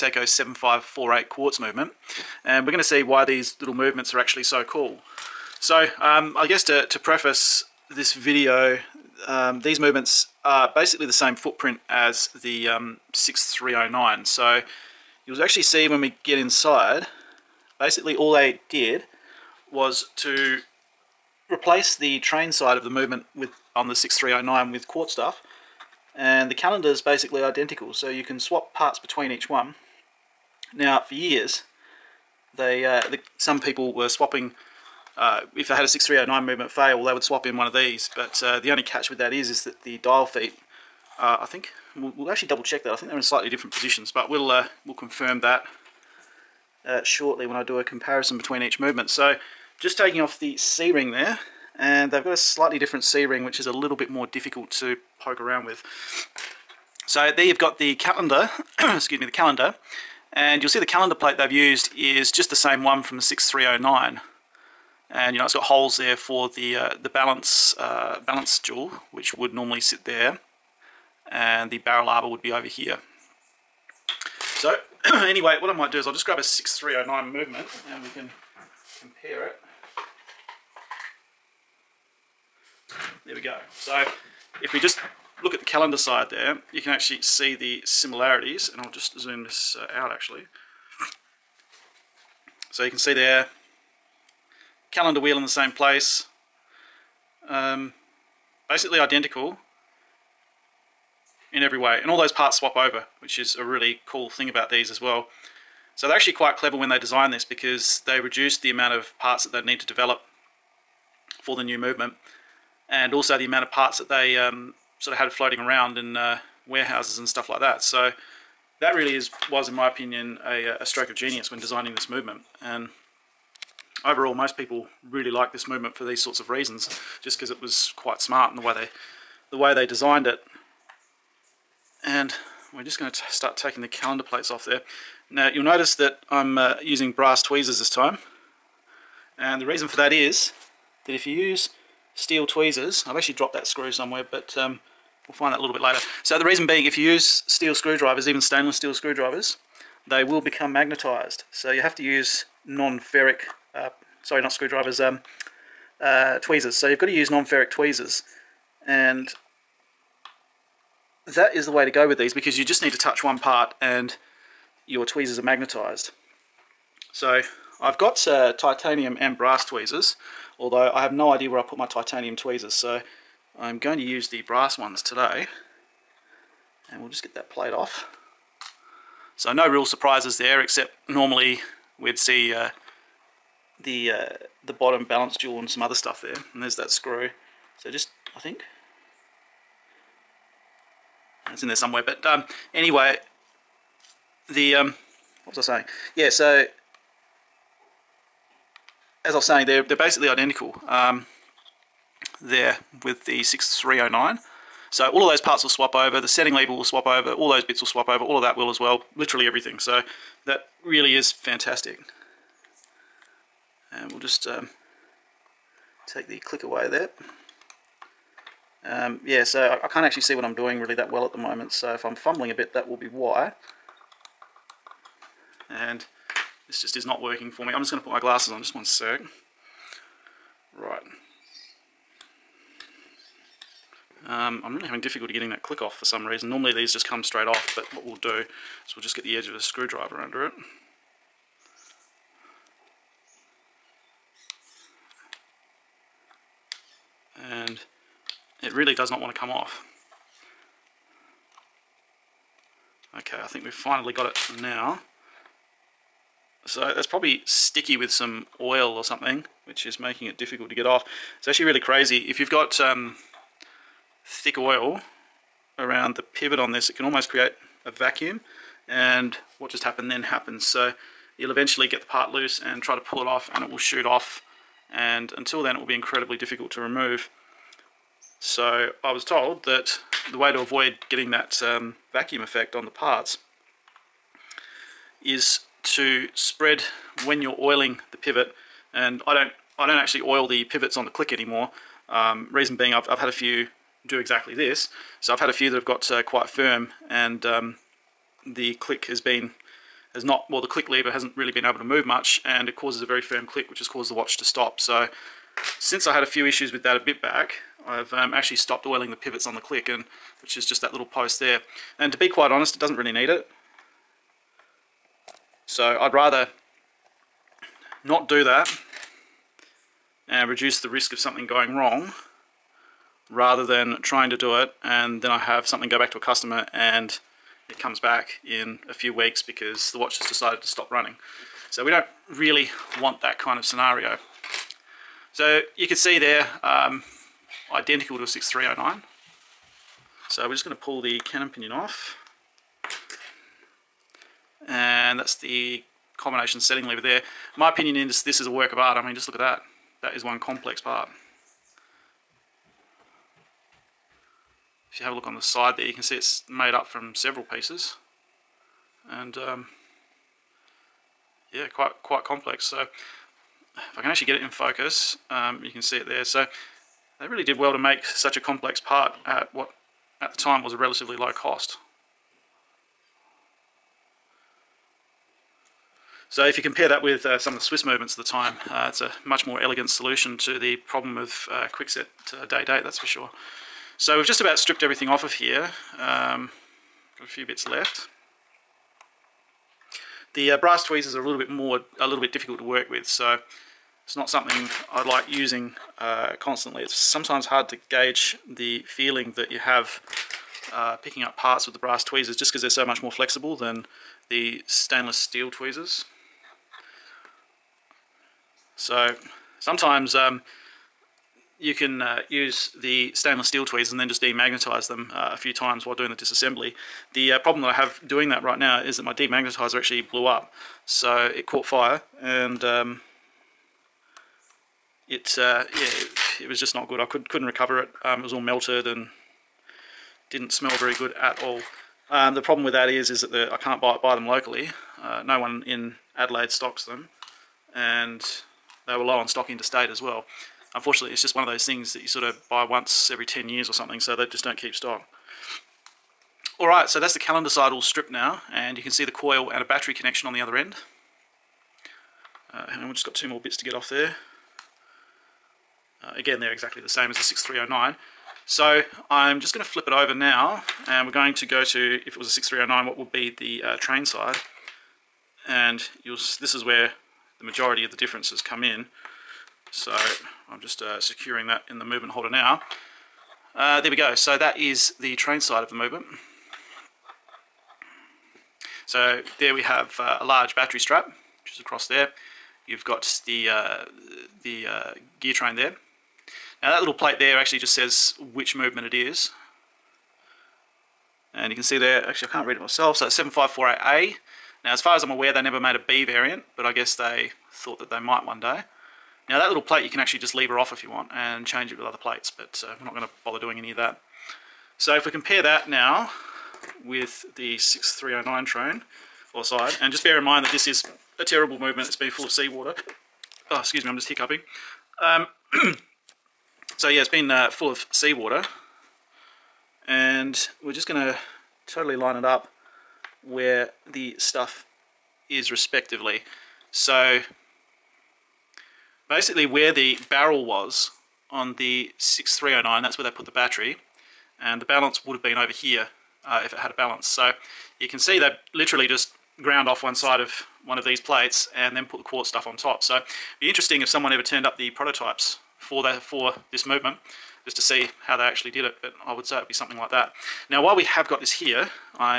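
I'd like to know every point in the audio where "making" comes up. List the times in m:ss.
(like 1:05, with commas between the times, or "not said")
4:19.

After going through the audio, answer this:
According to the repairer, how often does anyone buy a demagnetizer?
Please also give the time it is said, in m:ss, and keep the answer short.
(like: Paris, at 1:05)
Once every 10 years, at 7:22.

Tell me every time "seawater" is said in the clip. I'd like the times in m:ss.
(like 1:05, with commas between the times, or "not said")
8:32, 8:37.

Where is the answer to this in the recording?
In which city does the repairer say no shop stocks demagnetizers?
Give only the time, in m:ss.
7:16.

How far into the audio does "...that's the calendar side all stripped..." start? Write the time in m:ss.
7:26.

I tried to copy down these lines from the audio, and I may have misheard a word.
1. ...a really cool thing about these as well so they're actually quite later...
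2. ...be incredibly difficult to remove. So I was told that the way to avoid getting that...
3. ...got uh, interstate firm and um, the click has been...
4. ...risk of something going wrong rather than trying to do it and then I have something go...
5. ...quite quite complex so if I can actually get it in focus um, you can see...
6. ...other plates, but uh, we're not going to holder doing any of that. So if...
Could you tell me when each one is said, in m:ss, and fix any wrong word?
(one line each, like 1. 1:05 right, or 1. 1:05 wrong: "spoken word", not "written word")
1. 1:43 wrong: "clever", not "later"
2. 4:35 right
3. 4:55 wrong: "quite", not "interstate"
4. 5:20 right
5. 6:01 right
6. 8:21 wrong: "bother", not "holder".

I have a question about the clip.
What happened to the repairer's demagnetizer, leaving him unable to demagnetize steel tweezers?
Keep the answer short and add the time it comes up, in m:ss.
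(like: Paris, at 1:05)
It caught fire, at 7:01.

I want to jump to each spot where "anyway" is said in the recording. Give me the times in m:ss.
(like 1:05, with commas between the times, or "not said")
1:15, 3:12.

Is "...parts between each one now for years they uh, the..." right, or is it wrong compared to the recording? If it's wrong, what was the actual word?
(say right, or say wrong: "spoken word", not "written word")
right.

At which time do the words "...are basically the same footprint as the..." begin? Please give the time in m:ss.
0:10.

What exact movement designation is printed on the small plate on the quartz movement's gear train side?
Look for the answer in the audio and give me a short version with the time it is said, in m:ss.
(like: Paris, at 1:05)
7548A, at 8:13.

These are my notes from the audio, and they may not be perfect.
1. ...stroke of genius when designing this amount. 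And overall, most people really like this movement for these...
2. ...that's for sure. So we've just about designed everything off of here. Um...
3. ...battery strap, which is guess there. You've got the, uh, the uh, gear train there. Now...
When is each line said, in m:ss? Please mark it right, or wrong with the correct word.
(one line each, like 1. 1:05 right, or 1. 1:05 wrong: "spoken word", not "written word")
1. 2:00 wrong: "movement", not "amount"
2. 6:22 wrong: "stripped", not "designed"
3. 8:00 wrong: "across", not "guess".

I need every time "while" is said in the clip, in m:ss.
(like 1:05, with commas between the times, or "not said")
6:55, 9:10.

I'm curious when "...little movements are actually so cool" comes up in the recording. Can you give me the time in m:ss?
0:03.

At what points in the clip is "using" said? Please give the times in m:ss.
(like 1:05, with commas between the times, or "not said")
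2:16, 6:35.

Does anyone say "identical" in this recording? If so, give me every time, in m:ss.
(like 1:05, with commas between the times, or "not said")
0:27, 1:38, 3:20, 5:37.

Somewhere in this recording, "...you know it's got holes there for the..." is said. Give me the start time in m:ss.
1:05.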